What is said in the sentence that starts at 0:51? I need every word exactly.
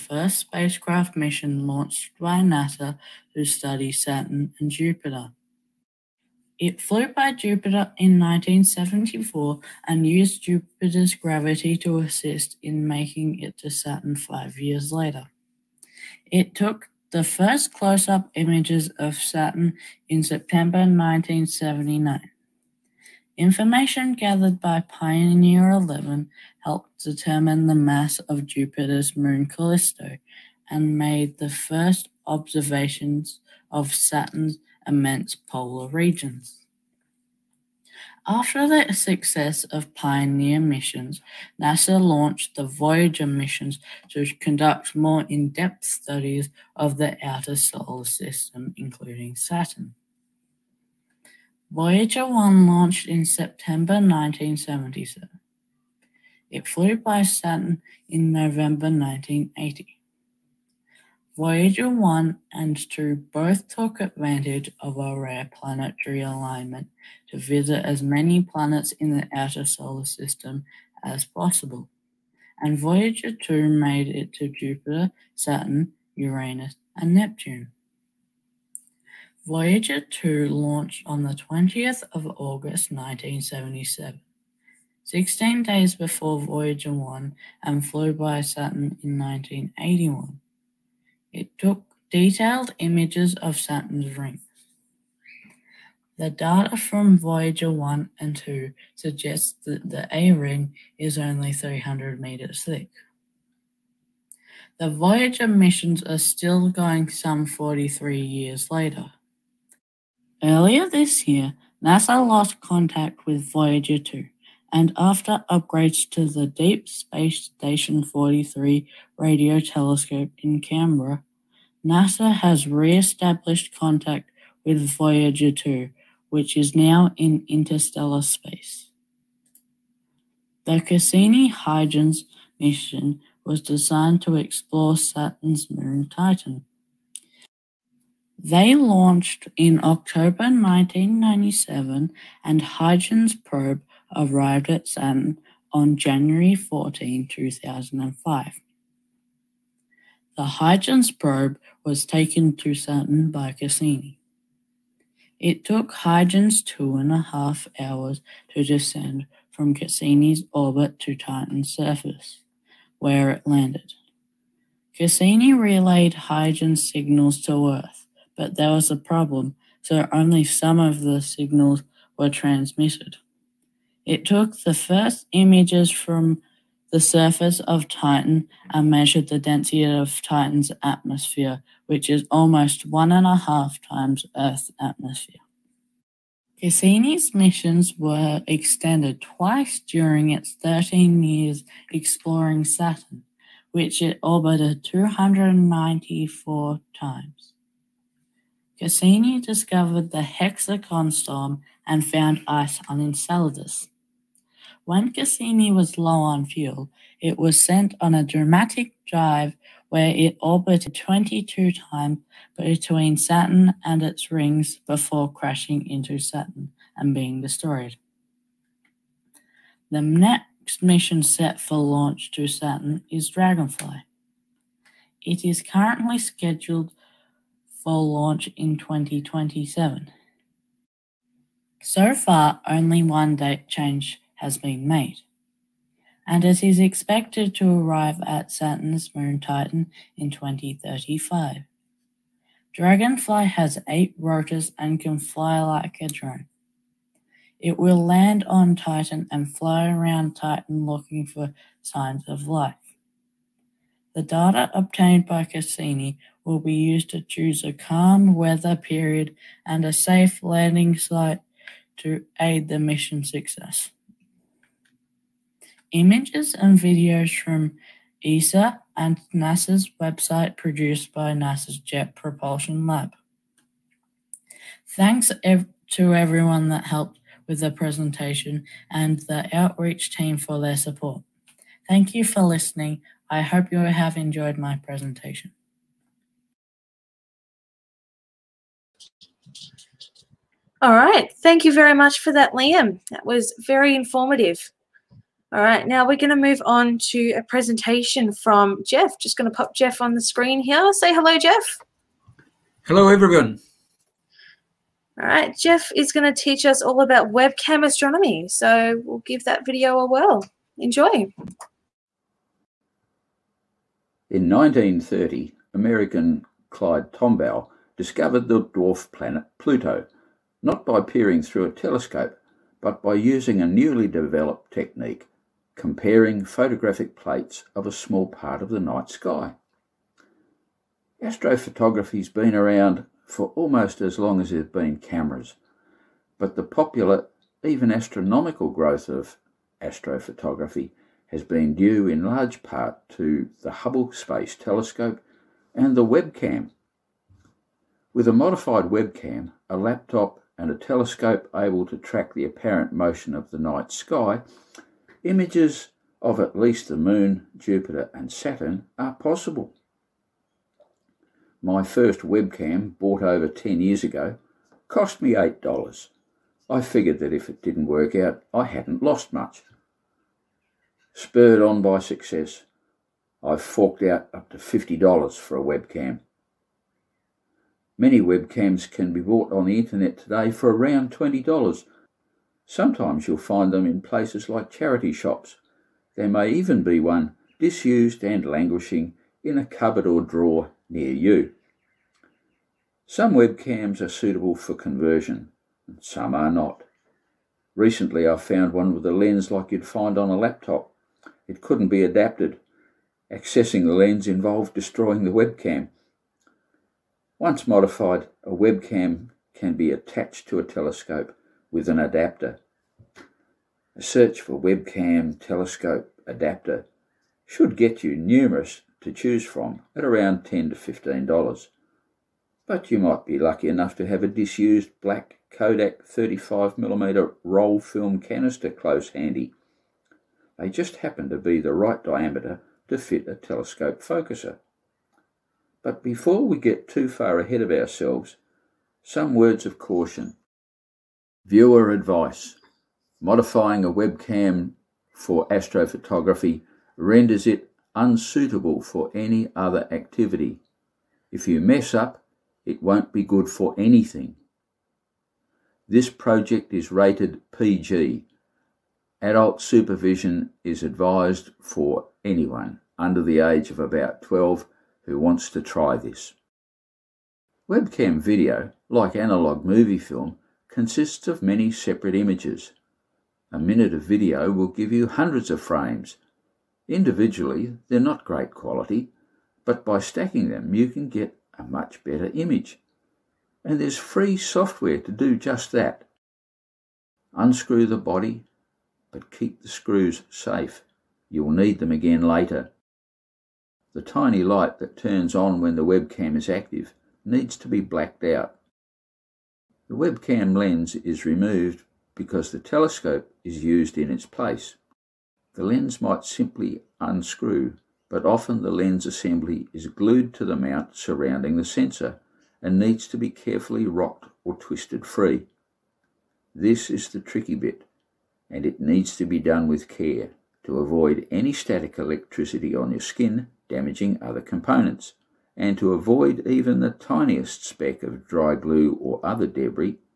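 Voyager 1 launched in September 1977.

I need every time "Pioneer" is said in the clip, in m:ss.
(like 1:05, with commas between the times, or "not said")
0:24, 0:39.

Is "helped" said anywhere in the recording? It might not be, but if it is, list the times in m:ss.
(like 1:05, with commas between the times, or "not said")
0:26, 4:36.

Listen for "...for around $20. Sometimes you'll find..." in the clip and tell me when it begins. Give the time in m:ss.
6:20.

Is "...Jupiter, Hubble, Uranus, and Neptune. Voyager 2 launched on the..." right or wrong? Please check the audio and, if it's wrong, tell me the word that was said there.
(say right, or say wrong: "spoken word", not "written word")
wrong: "Saturn", not "Hubble".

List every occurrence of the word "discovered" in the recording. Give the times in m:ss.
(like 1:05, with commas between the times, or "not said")
3:19, 5:17.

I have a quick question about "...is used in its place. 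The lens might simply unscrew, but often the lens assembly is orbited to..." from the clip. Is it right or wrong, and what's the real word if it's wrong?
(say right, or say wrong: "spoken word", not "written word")
wrong: "glued", not "orbited".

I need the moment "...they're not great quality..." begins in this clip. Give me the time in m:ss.
7:57.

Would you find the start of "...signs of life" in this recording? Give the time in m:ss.
4:11.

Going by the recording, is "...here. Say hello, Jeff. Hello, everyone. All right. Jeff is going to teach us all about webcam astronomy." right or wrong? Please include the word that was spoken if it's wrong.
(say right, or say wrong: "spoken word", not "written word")
right.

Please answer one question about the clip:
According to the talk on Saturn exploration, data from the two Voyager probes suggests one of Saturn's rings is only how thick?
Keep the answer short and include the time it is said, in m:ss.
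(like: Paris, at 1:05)
300 meters, at 1:41.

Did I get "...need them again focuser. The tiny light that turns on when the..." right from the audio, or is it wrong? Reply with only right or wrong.
wrong.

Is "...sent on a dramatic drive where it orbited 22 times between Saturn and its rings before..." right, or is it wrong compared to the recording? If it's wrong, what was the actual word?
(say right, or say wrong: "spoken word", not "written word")
right.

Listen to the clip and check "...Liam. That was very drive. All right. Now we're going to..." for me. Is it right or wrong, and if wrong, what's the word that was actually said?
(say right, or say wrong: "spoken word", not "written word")
wrong: "informative", not "drive".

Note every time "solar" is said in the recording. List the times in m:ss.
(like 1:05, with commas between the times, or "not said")
0:47, 1:09.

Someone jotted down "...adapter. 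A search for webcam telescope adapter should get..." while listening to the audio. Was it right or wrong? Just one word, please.
right.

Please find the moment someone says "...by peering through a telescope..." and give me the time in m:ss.
5:20.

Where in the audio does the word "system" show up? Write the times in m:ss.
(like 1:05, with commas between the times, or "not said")
0:48, 1:10.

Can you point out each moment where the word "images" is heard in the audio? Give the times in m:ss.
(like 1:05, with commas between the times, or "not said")
0:18, 1:32, 2:55, 4:25, 5:55, 7:52, 8:02.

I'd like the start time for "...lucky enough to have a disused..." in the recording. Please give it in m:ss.
7:03.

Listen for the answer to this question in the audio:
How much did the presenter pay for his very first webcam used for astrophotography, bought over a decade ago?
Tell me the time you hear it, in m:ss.
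6:05.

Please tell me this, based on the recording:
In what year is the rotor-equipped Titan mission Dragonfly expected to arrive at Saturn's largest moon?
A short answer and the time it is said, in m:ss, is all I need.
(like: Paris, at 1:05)
2035, at 4:00.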